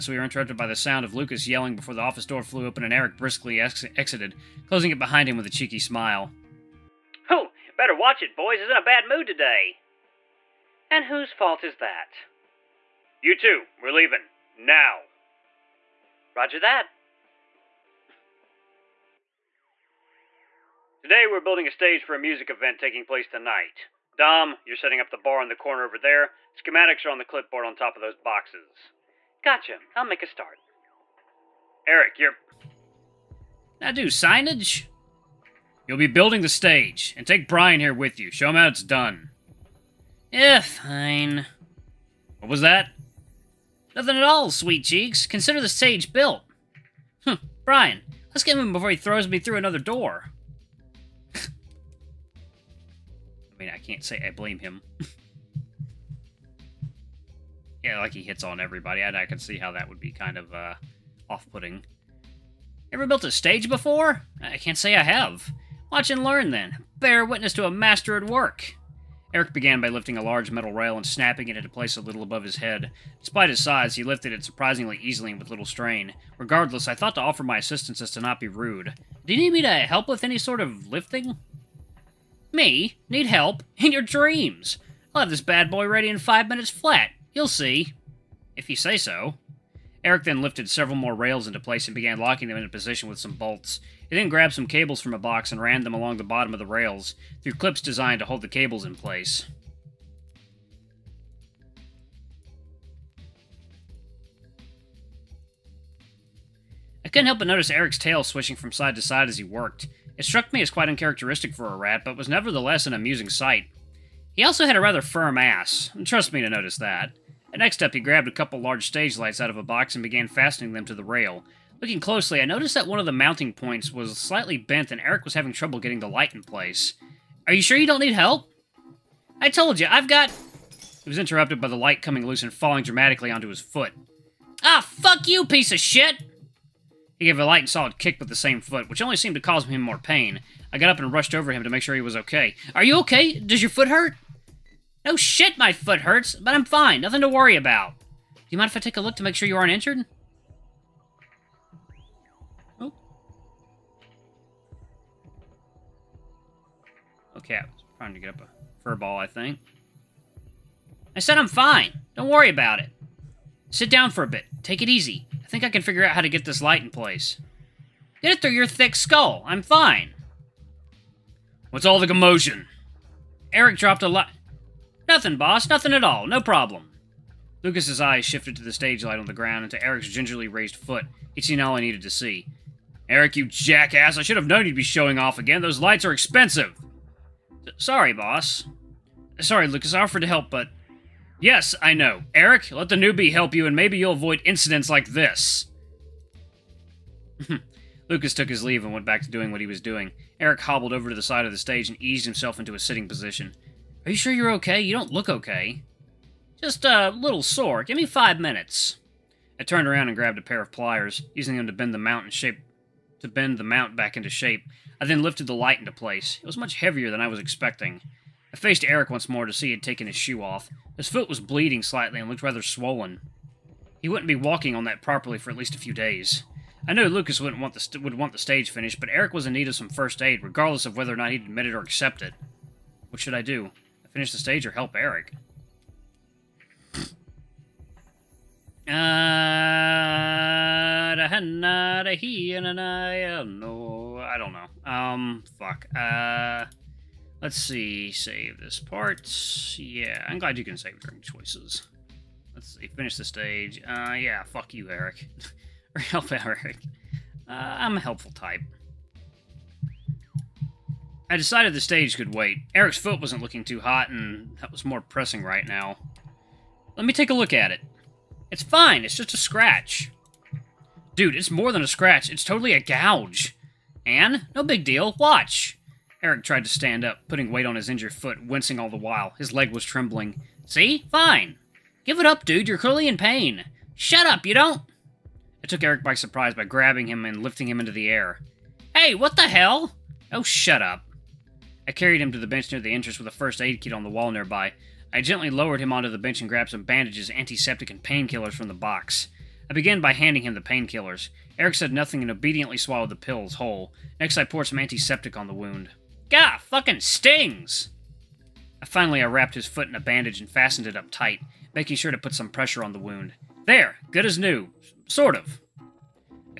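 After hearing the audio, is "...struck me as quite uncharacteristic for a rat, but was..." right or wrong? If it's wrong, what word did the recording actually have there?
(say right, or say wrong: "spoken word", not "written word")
right.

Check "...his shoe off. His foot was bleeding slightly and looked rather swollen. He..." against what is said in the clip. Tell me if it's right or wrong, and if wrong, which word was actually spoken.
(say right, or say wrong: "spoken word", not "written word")
right.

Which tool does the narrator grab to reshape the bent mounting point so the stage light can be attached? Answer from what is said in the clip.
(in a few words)
pliers.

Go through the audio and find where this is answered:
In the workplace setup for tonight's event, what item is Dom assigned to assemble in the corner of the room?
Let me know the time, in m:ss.
0:25.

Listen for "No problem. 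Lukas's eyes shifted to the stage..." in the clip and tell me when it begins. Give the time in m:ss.
2:56.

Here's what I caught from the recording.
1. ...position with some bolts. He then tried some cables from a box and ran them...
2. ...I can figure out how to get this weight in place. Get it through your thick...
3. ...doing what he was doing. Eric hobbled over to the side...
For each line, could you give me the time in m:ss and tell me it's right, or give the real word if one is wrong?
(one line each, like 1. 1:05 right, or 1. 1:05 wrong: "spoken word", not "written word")
1. 1:32 wrong: "grabbed", not "tried"
2. 2:45 wrong: "light", not "weight"
3. 3:19 right.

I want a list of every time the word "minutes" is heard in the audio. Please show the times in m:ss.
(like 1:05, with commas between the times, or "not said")
1:26, 3:28.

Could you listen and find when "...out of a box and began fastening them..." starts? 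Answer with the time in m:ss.
1:59.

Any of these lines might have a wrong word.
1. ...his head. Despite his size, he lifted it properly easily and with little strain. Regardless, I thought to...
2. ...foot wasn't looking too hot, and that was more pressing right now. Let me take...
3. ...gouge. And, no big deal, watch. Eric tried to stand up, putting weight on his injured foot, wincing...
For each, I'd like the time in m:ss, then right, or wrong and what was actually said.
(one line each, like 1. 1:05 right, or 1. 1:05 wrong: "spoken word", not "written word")
1. 1:12 wrong: "surprisingly", not "properly"
2. 4:22 right
3. 4:32 right.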